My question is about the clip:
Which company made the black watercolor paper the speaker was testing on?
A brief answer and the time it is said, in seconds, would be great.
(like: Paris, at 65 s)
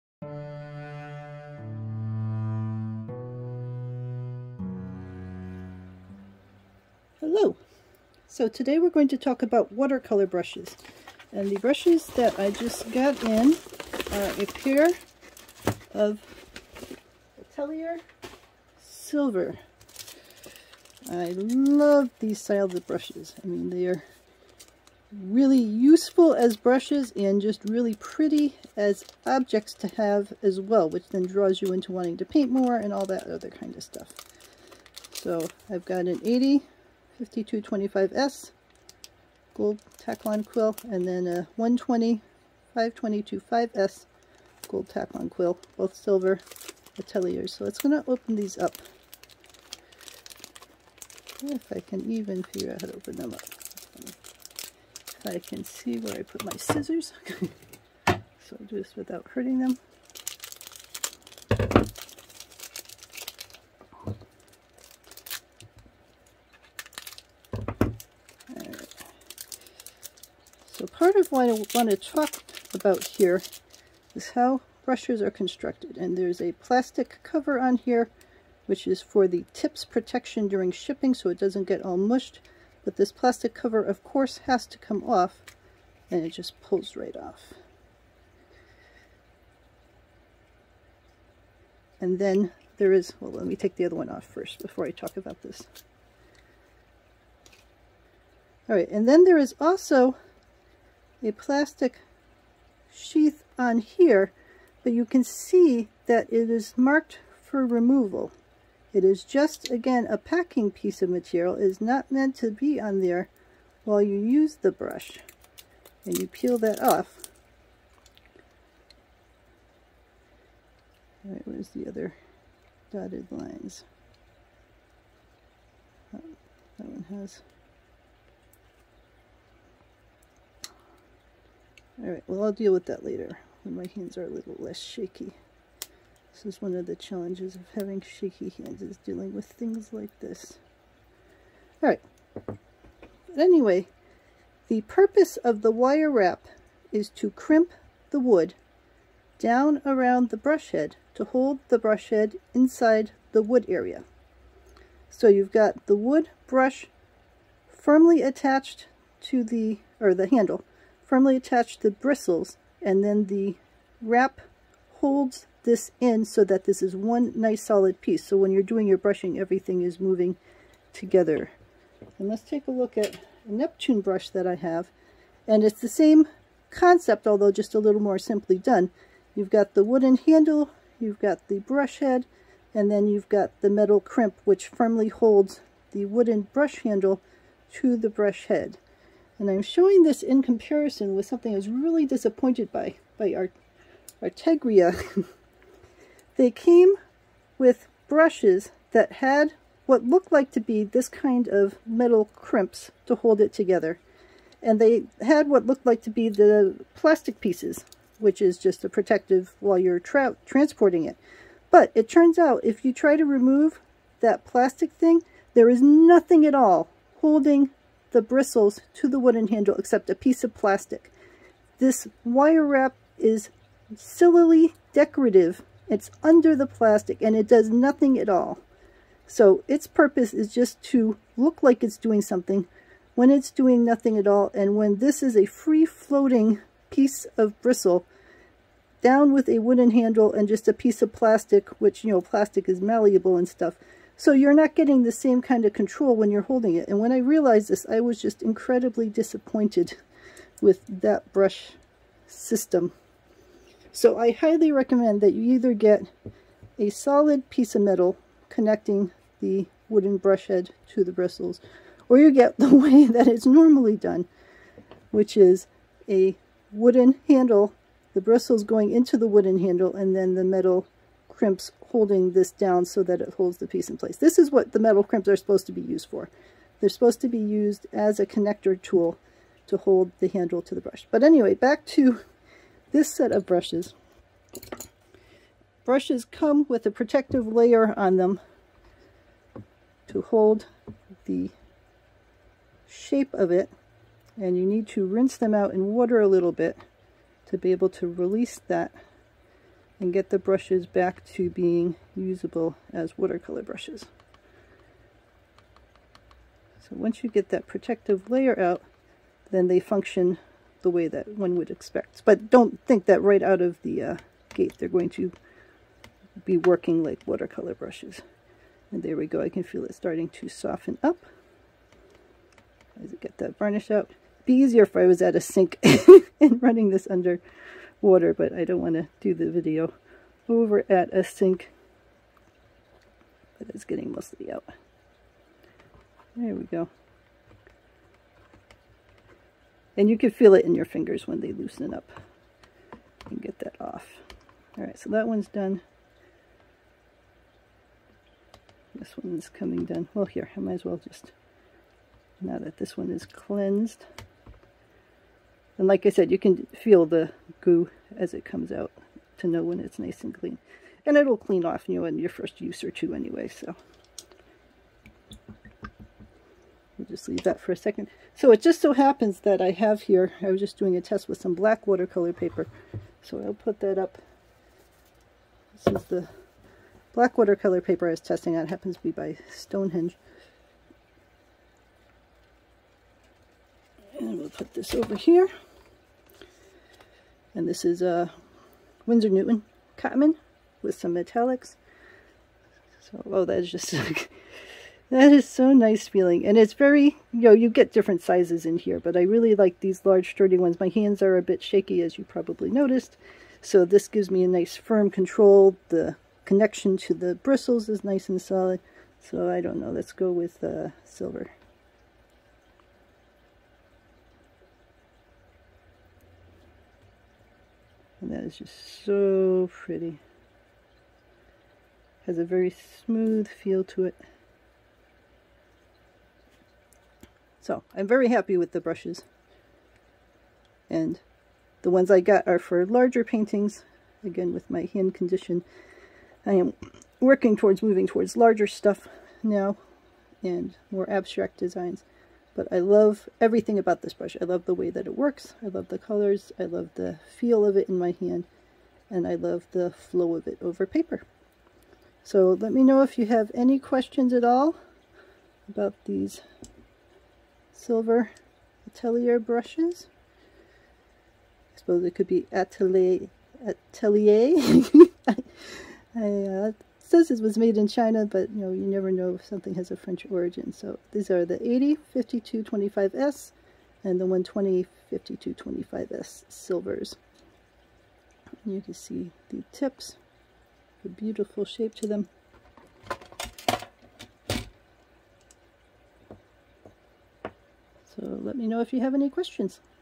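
Stonehenge, at 379 s.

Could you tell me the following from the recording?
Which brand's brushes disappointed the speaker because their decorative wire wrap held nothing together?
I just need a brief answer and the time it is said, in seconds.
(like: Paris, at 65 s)
Art Artegria, at 193 s.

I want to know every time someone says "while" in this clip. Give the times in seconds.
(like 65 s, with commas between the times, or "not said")
113 s, 209 s.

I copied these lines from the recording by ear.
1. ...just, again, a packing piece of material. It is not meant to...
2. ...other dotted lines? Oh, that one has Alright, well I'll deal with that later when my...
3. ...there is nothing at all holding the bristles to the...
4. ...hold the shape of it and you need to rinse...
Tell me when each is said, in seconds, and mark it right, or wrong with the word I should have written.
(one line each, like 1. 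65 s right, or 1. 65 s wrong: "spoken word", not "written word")
1. 109 s right
2. 121 s right
3. 215 s right
4. 290 s right.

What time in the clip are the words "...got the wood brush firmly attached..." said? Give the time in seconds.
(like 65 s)
155 s.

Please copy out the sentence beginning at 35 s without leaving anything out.
So I've got an 80 5225S gold Taklon quill, and then a 120 522.5S gold Taklon quill, both silver ateliers.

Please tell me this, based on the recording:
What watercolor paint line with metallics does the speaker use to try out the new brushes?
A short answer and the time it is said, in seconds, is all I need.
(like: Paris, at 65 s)
Winsor Newton Cotman, at 389 s.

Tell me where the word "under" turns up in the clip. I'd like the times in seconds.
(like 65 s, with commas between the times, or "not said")
226 s, 327 s.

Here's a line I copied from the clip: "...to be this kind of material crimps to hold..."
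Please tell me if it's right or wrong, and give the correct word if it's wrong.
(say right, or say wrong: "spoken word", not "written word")
wrong: "metal", not "material".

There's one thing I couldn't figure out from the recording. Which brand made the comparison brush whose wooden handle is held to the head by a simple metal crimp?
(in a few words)
Neptune.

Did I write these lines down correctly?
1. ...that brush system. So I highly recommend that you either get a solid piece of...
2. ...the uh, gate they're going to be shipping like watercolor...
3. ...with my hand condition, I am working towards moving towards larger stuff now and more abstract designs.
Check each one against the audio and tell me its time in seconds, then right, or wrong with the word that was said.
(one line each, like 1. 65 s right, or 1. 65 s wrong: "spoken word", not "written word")
1. 251 s right
2. 313 s wrong: "working", not "shipping"
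3. 434 s right.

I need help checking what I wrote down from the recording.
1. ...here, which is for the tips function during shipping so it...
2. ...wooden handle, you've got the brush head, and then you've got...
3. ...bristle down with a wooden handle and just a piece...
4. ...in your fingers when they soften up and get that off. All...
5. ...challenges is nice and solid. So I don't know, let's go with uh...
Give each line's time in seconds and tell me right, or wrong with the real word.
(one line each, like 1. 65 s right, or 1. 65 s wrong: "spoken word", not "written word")
1. 77 s wrong: "protection", not "function"
2. 179 s right
3. 237 s right
4. 340 s wrong: "loosen", not "soften"
5. 407 s wrong: "bristles", not "challenges".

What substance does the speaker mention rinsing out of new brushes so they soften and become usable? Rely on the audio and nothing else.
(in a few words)
Varnish.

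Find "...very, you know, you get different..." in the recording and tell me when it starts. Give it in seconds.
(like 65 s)
396 s.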